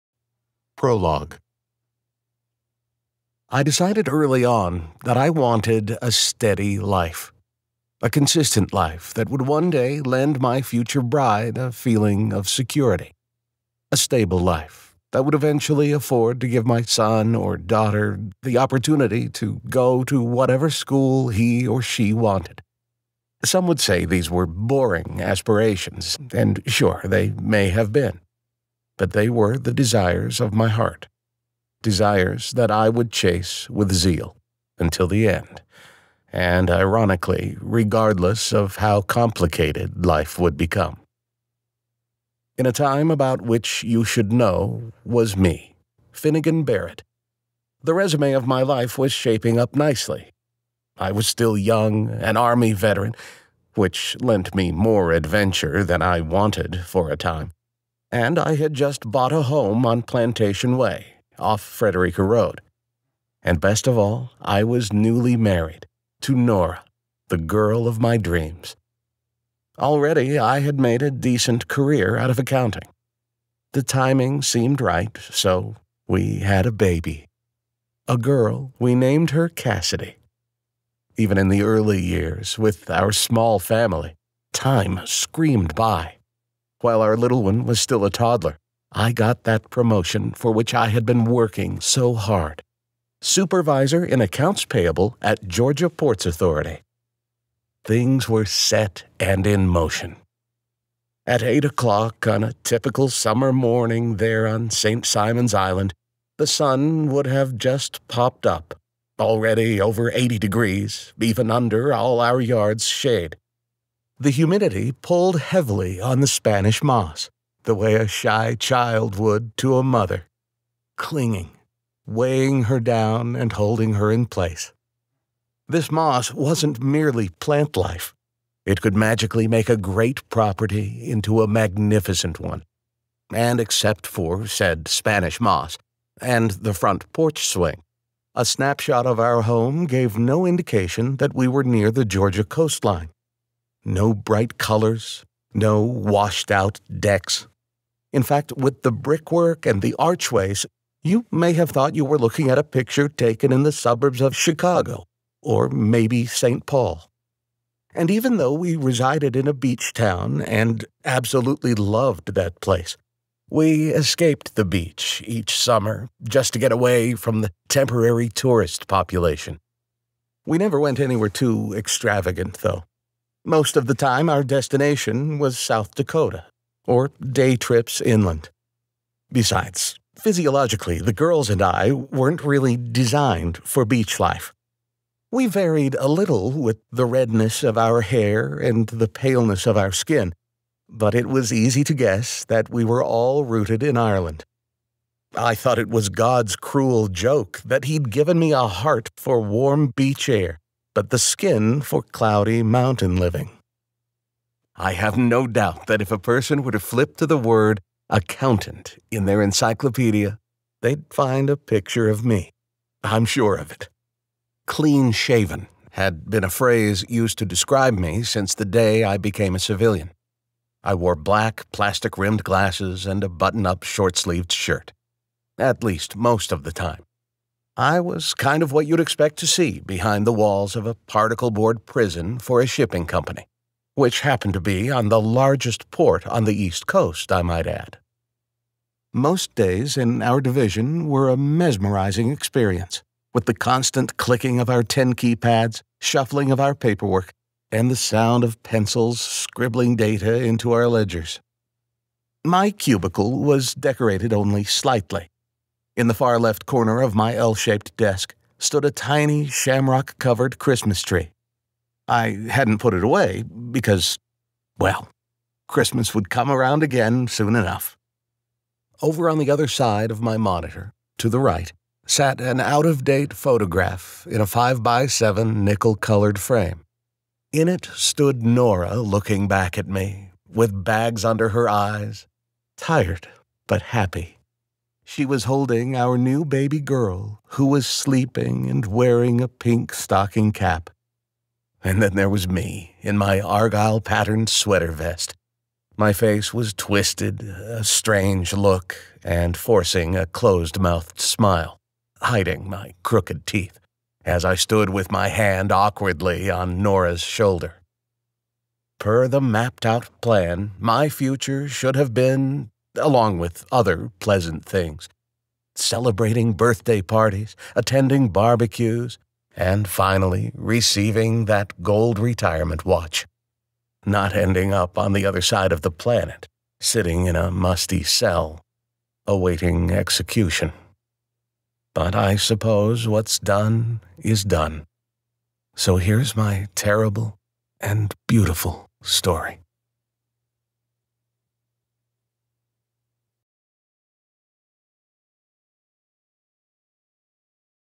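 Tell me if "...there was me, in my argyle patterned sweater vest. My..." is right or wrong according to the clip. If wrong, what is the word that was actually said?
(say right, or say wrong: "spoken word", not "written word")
right.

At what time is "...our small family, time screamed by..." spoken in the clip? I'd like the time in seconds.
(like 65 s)
82 s.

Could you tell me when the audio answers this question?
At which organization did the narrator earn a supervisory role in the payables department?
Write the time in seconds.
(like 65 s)
95 s.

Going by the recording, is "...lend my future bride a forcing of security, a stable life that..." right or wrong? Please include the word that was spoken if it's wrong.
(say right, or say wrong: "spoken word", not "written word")
wrong: "feeling", not "forcing".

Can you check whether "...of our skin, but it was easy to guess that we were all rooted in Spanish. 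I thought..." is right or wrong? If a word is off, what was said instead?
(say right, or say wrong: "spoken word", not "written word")
wrong: "Ireland", not "Spanish".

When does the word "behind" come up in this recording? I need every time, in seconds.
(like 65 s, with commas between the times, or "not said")
229 s.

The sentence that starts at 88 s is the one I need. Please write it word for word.
I got that promotion for which I had been working so hard.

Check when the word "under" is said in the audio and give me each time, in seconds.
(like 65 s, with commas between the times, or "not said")
111 s, 281 s.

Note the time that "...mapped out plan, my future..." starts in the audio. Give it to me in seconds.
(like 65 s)
309 s.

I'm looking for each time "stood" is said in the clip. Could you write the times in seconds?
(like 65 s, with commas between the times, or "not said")
258 s, 277 s, 304 s.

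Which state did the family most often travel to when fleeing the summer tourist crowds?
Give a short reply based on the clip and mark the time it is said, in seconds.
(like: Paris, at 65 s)
South Dakota, at 175 s.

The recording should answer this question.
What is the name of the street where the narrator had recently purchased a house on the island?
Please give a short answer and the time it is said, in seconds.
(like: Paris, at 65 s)
Plantation Way, at 60 s.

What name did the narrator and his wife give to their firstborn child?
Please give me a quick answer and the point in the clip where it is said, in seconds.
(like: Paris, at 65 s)
Cassidy, at 79 s.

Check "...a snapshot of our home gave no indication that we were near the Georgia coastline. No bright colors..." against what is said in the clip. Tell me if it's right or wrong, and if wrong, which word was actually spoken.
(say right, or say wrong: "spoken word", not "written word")
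right.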